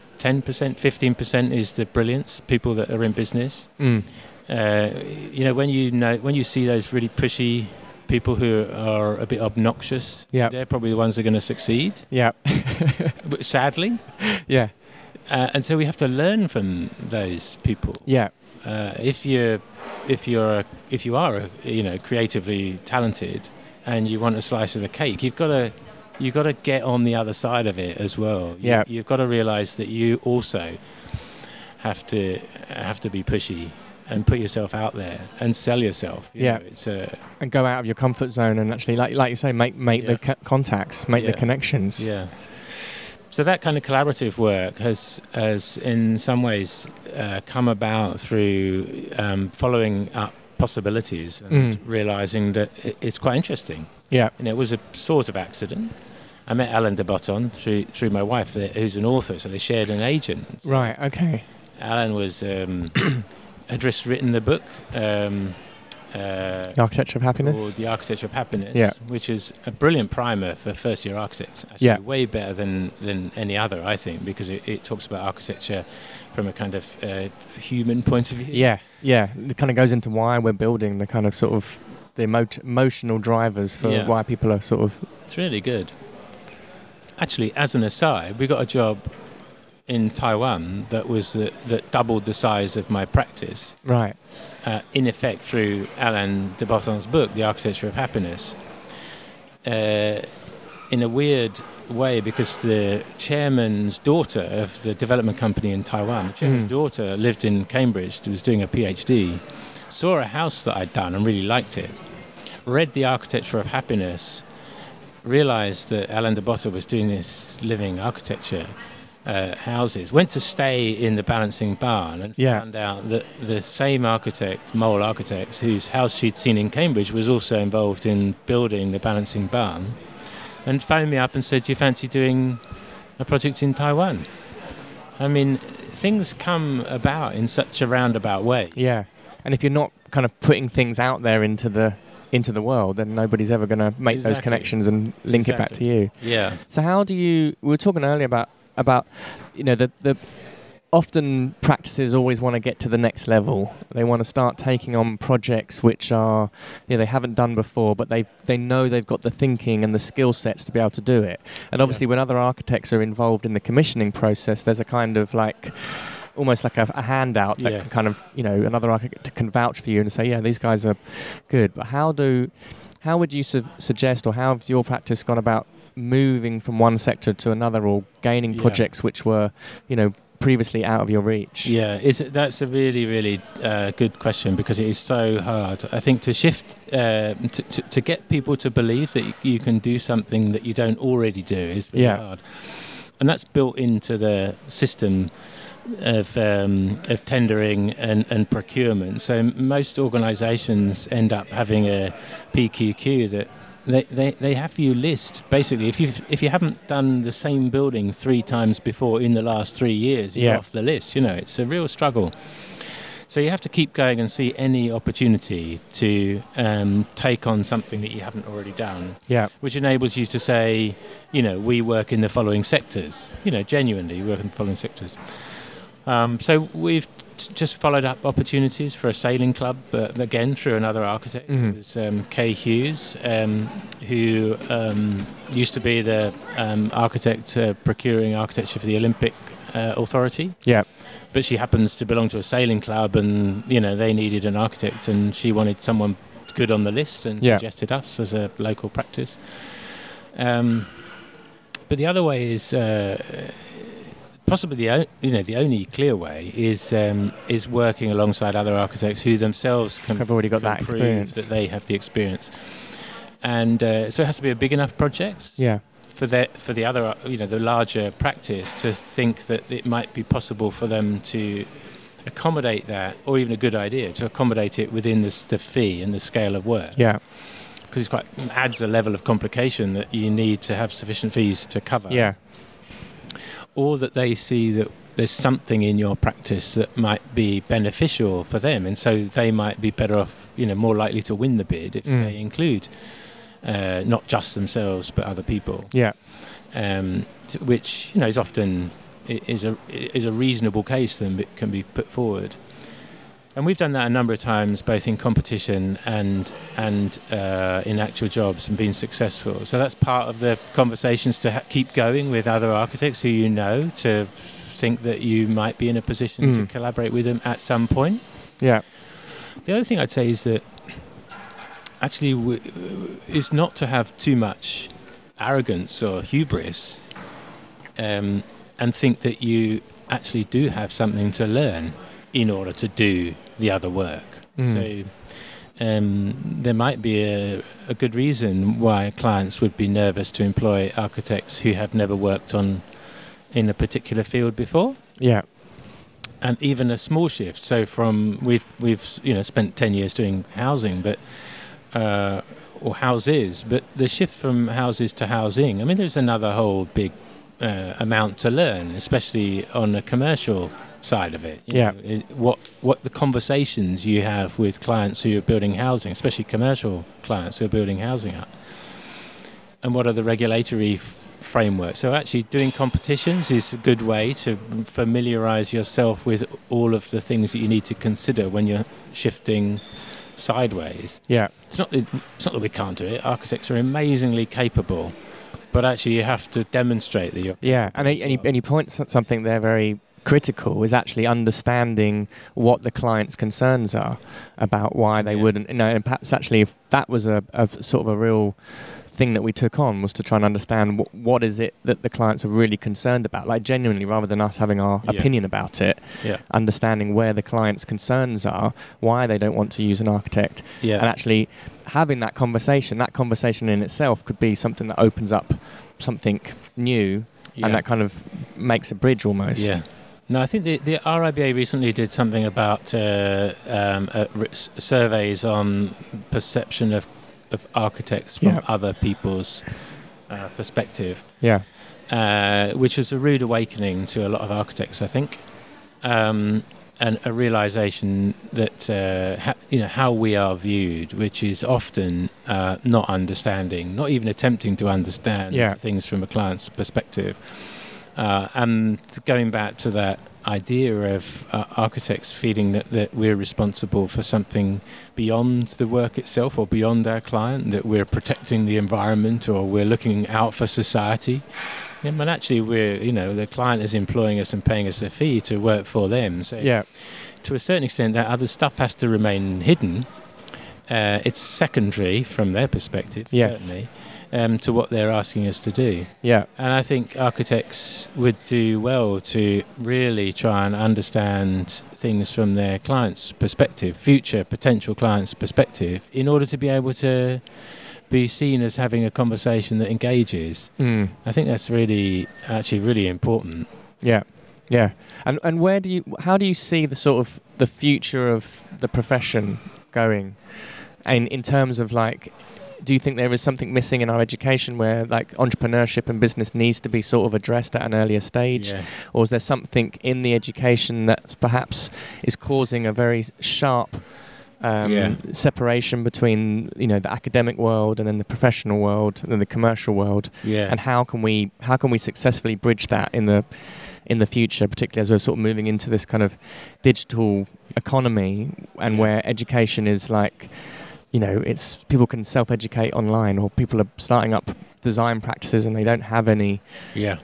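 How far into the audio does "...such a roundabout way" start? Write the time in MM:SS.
02:17.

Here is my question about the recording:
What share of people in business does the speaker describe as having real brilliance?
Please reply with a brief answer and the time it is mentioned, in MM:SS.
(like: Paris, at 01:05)
10%, 15%, at 00:00.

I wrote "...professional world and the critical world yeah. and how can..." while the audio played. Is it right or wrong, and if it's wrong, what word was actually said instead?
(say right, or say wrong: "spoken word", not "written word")
wrong: "commercial", not "critical".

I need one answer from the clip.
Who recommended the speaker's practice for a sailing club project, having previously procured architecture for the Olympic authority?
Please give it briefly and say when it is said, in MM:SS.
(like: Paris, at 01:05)
Kay Hughes, at 03:52.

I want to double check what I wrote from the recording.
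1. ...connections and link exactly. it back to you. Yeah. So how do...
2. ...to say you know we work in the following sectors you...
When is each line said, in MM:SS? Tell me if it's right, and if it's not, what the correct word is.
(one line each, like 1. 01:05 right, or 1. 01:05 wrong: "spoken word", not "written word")
1. 02:24 right
2. 03:40 right.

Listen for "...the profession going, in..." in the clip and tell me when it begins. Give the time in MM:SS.
08:18.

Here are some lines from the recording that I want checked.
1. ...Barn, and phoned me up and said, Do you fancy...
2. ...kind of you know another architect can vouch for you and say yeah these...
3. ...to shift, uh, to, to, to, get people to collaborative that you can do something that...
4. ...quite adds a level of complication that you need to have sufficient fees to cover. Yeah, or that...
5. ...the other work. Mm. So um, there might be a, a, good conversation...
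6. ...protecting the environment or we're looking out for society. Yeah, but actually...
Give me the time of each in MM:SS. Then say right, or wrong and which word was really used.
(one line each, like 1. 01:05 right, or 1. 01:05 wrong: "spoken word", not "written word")
1. 02:09 right
2. 02:47 right
3. 03:06 wrong: "believe", not "collaborative"
4. 04:38 right
5. 05:33 wrong: "reason", not "conversation"
6. 07:38 right.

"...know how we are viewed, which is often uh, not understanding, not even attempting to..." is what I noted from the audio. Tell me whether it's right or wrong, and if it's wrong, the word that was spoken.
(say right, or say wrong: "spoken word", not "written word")
right.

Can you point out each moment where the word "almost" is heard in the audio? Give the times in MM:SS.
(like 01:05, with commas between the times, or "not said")
02:46, 06:59.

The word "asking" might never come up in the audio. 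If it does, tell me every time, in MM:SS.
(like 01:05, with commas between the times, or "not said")
07:55.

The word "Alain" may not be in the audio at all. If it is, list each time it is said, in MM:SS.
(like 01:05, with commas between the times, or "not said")
00:56, 01:35, 01:56.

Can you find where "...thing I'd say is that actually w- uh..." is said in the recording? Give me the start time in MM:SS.
05:19.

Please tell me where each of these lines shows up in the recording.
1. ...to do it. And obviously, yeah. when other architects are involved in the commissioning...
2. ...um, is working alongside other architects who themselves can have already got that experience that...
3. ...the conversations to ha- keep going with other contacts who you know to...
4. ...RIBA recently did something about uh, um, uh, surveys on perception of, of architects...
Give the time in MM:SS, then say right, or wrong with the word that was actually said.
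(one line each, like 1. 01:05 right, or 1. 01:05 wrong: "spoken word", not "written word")
1. 02:40 right
2. 04:16 right
3. 05:10 wrong: "architects", not "contacts"
4. 07:01 right.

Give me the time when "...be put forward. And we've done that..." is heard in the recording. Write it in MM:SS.
05:01.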